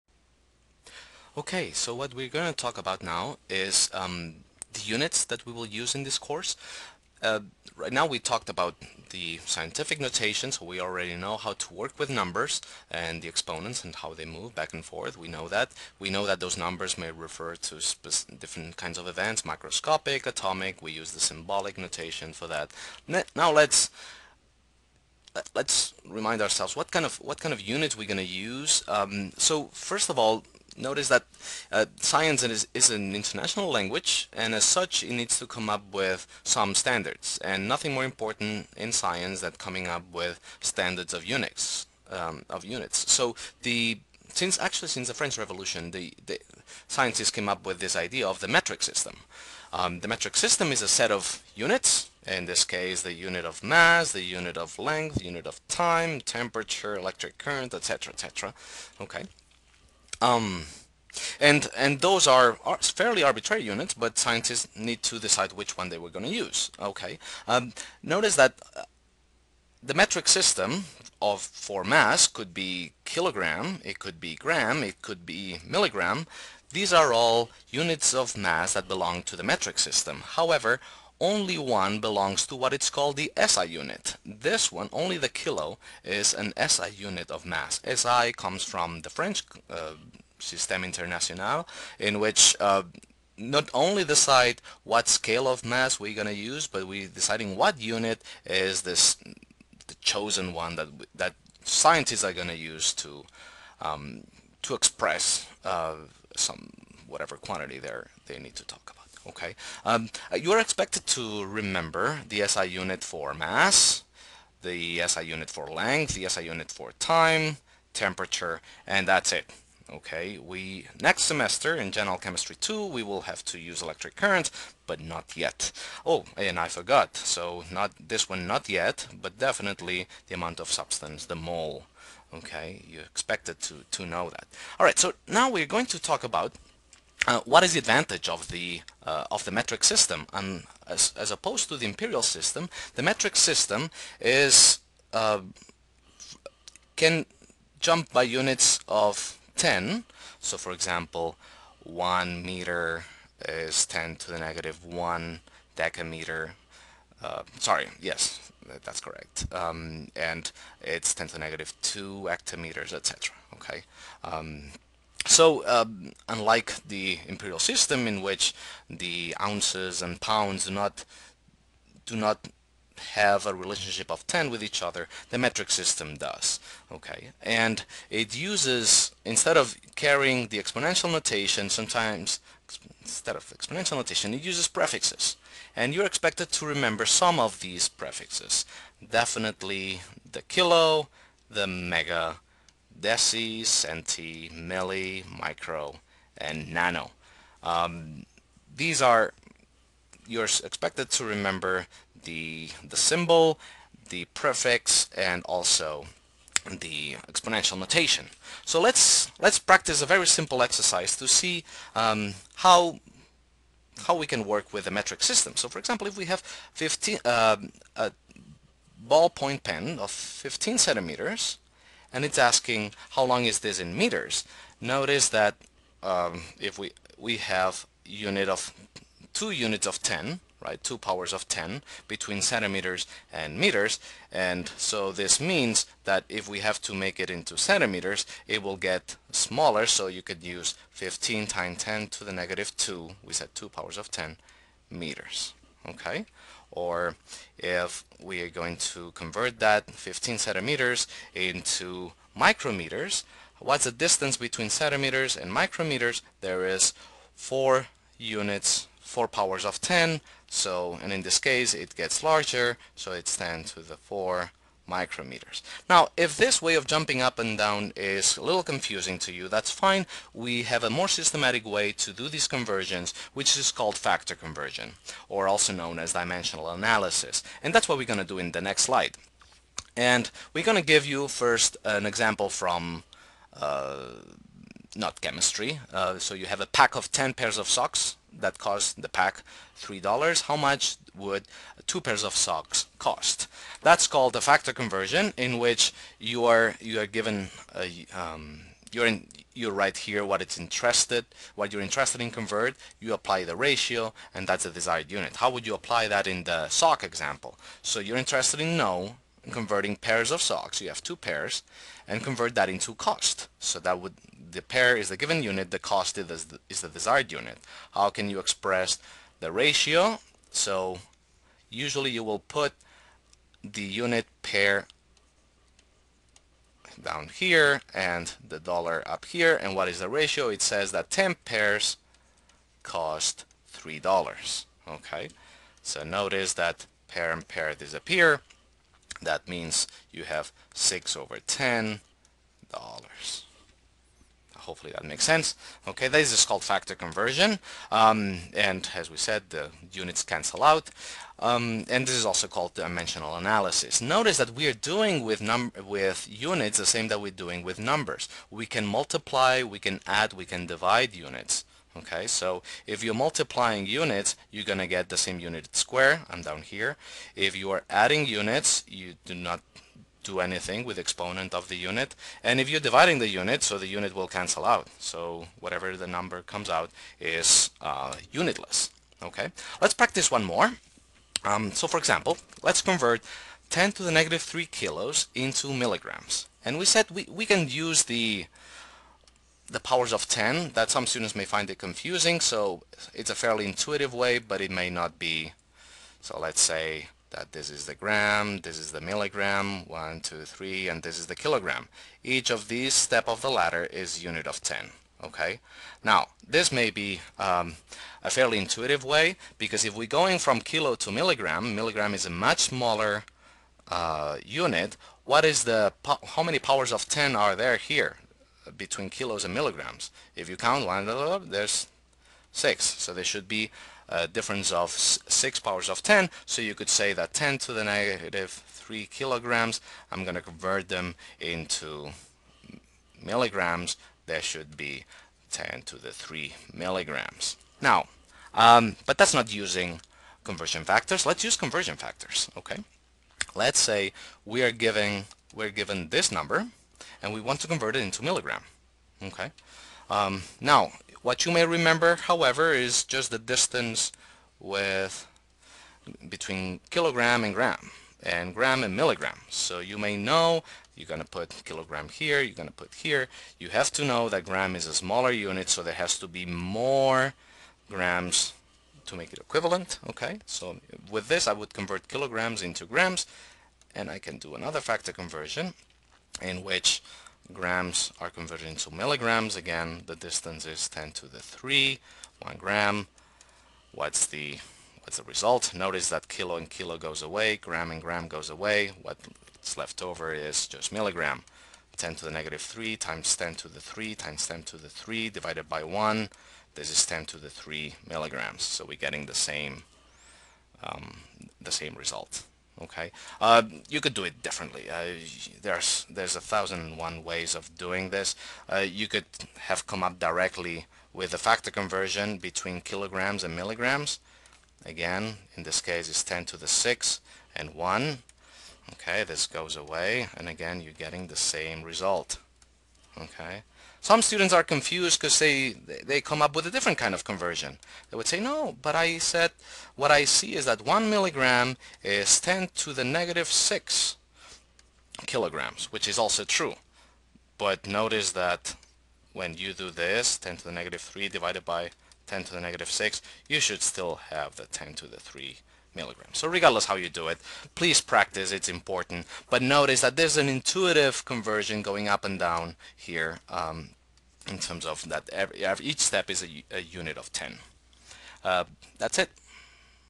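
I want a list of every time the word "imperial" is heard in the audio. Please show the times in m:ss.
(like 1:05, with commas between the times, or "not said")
2:21, 2:47.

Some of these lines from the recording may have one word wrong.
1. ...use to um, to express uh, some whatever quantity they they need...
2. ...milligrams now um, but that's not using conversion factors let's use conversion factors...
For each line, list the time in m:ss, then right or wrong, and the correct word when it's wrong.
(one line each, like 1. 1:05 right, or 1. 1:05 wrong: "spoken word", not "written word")
1. 1:42 right
2. 7:16 right.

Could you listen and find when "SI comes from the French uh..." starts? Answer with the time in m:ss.
1:27.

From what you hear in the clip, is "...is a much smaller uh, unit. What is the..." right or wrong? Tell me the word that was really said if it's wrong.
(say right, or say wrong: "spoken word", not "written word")
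right.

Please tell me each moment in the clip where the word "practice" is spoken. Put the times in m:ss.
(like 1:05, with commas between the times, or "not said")
3:29, 6:19, 9:08.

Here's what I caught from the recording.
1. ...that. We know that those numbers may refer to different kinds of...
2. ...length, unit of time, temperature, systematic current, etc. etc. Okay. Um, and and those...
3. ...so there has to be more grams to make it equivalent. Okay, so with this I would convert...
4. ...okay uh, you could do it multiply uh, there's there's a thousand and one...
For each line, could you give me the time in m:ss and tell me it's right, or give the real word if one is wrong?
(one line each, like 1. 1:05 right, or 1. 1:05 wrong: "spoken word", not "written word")
1. 0:15 right
2. 0:54 wrong: "electric", not "systematic"
3. 7:45 right
4. 8:22 wrong: "differently", not "multiply".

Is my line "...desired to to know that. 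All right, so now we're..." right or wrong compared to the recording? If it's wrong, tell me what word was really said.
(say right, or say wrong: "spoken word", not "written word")
wrong: "expected", not "desired".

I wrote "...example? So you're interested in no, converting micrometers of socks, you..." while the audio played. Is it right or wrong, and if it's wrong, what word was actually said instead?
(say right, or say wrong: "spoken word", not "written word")
wrong: "pairs", not "micrometers".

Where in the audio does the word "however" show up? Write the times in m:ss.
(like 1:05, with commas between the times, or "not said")
1:20, 7:32.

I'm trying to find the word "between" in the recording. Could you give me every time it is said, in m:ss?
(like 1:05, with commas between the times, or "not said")
3:52, 4:14, 6:58, 7:36, 8:32.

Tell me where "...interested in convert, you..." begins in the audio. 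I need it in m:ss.
5:01.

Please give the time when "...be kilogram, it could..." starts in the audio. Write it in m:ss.
1:12.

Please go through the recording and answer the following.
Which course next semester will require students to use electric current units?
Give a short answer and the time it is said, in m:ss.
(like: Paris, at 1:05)
General Chemistry 2, at 2:01.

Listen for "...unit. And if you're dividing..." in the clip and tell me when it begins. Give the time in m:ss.
6:11.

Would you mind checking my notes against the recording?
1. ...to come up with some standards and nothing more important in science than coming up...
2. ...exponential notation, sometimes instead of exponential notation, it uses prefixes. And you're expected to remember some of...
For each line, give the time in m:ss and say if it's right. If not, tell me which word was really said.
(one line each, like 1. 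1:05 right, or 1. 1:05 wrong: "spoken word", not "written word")
1. 0:35 right
2. 3:00 right.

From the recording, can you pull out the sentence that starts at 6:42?
Each of these step of the ladder is unit of 10.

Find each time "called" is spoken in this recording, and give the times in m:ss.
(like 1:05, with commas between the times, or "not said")
1:22, 4:33, 4:54, 5:46, 5:52.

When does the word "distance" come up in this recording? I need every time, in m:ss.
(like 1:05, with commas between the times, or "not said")
4:13, 7:33, 8:00.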